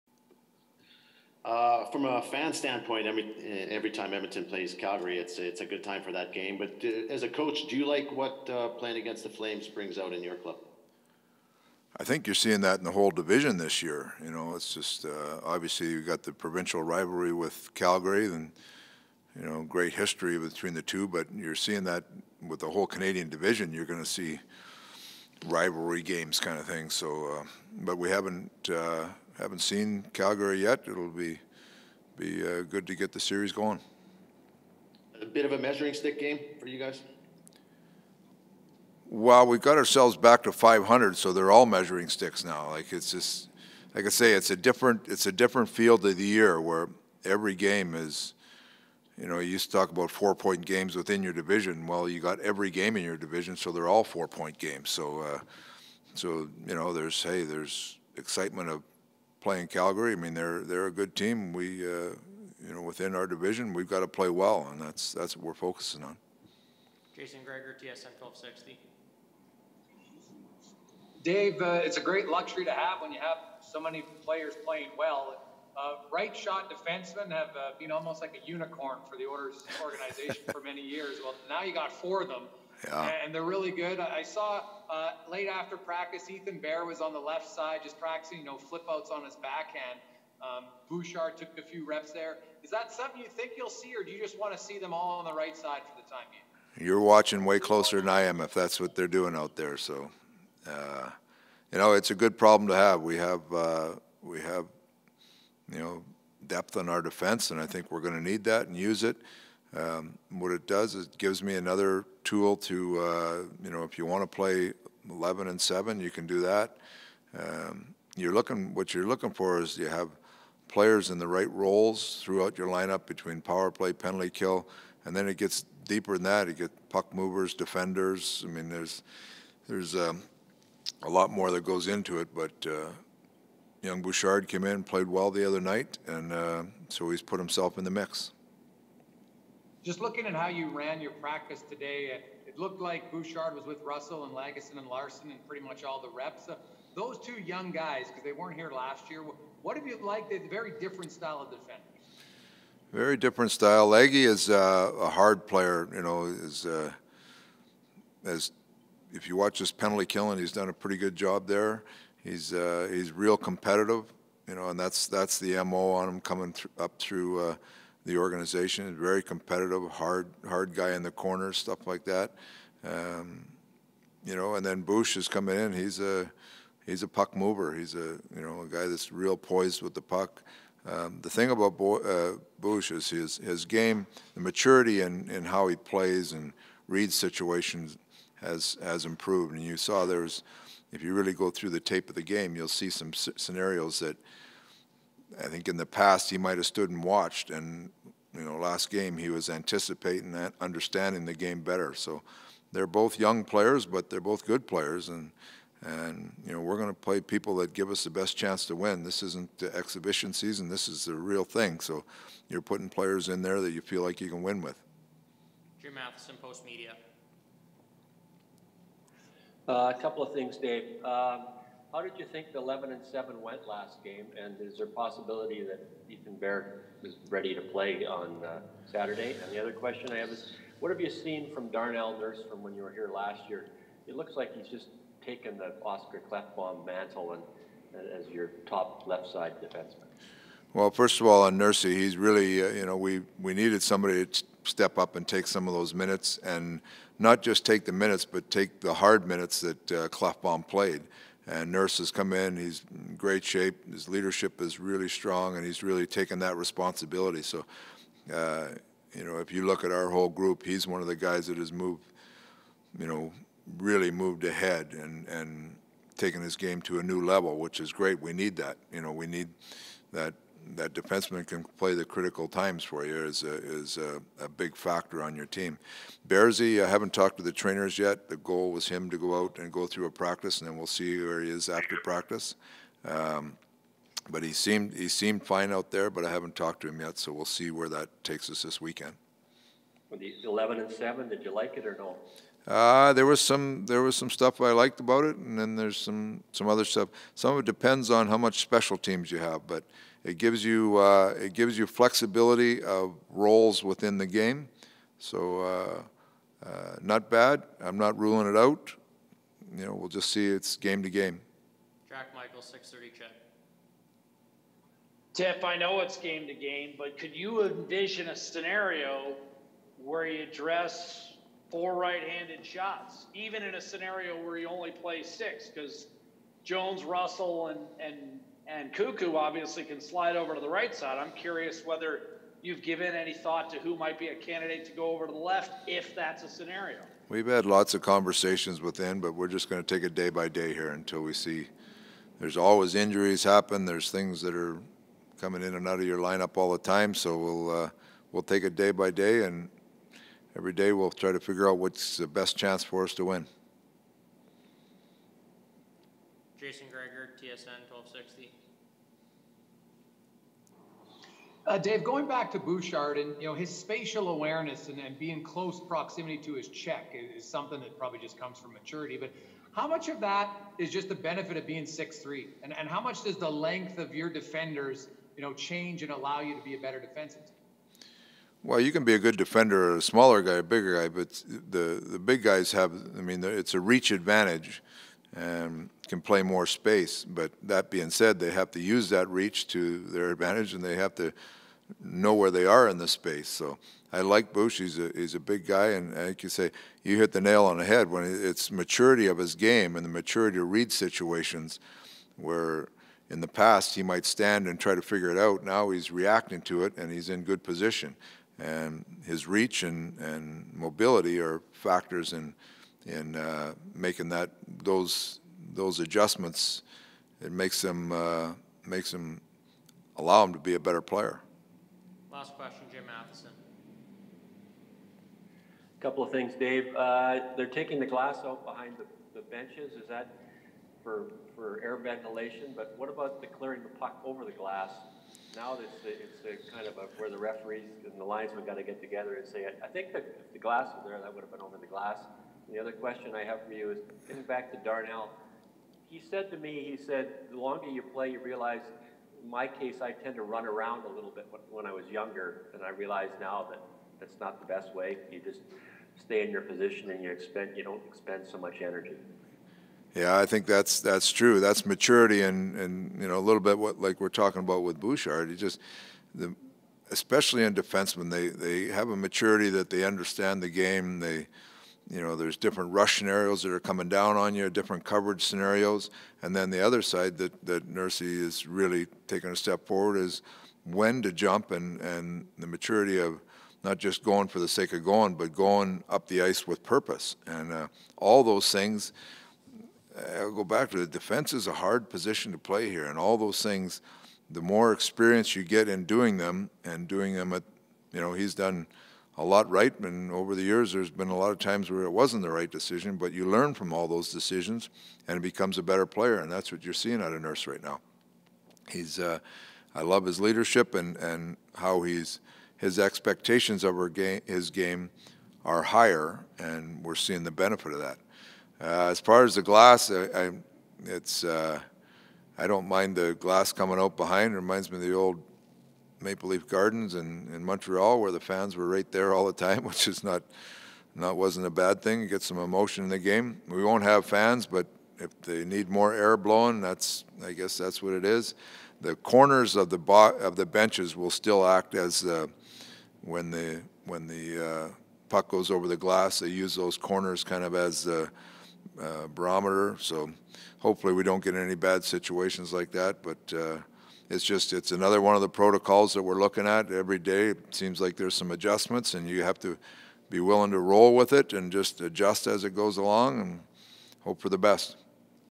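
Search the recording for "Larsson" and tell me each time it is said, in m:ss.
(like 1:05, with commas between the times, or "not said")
2:24.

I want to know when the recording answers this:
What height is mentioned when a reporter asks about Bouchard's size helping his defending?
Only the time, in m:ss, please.
6:11.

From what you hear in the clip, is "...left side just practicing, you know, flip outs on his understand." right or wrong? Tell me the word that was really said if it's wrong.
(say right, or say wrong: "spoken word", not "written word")
wrong: "backhand", not "understand".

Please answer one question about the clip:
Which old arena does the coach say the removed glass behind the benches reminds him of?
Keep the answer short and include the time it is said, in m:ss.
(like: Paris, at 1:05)
Maple Leaf Gardens, at 8:46.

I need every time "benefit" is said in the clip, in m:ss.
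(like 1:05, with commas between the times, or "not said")
6:11, 8:37.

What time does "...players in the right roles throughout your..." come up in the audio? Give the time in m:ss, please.
2:00.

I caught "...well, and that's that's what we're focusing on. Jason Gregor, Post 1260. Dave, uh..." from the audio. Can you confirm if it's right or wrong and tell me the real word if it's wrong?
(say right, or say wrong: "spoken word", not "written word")
wrong: "TSN", not "Post".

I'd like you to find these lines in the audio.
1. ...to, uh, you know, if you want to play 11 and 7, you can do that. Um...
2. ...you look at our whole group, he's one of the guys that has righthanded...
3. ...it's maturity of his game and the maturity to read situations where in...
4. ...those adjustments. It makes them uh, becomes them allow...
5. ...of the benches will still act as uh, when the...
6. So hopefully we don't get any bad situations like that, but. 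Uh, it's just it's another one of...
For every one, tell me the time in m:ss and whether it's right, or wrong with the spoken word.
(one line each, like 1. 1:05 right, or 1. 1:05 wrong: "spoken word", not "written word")
1. 1:52 right
2. 4:19 wrong: "moved", not "righthanded"
3. 6:38 right
4. 6:55 wrong: "makes", not "becomes"
5. 9:00 right
6. 9:09 right.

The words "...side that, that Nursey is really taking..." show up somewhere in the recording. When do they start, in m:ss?
7:57.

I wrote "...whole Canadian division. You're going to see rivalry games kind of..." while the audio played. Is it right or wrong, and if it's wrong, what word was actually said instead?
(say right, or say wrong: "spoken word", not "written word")
right.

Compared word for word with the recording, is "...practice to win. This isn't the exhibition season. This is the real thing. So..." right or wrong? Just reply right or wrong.
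wrong.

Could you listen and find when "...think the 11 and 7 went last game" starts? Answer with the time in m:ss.
3:42.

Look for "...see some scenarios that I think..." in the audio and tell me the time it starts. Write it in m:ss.
3:12.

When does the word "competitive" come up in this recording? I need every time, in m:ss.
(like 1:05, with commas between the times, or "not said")
2:43, 2:49.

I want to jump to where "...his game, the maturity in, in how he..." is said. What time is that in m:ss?
3:03.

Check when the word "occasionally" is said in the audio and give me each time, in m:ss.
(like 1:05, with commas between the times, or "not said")
not said.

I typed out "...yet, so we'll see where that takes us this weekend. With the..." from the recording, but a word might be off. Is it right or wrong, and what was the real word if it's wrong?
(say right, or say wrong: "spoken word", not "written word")
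right.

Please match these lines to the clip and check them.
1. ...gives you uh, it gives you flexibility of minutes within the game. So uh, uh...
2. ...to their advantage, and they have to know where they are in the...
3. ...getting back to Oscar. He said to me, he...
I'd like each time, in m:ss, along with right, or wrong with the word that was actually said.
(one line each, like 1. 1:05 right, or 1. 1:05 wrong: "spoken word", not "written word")
1. 5:00 wrong: "roles", not "minutes"
2. 6:29 right
3. 7:24 wrong: "Darnell", not "Oscar".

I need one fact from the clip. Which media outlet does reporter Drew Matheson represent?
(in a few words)
Post Media.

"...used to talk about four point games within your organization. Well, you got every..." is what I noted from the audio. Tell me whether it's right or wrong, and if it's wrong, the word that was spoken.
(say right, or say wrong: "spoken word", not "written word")
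wrong: "division", not "organization".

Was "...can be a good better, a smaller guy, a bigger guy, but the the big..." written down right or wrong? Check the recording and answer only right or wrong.
wrong.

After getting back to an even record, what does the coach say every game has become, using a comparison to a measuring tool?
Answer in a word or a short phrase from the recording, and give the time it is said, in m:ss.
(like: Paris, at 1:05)
measuring sticks, at 0:41.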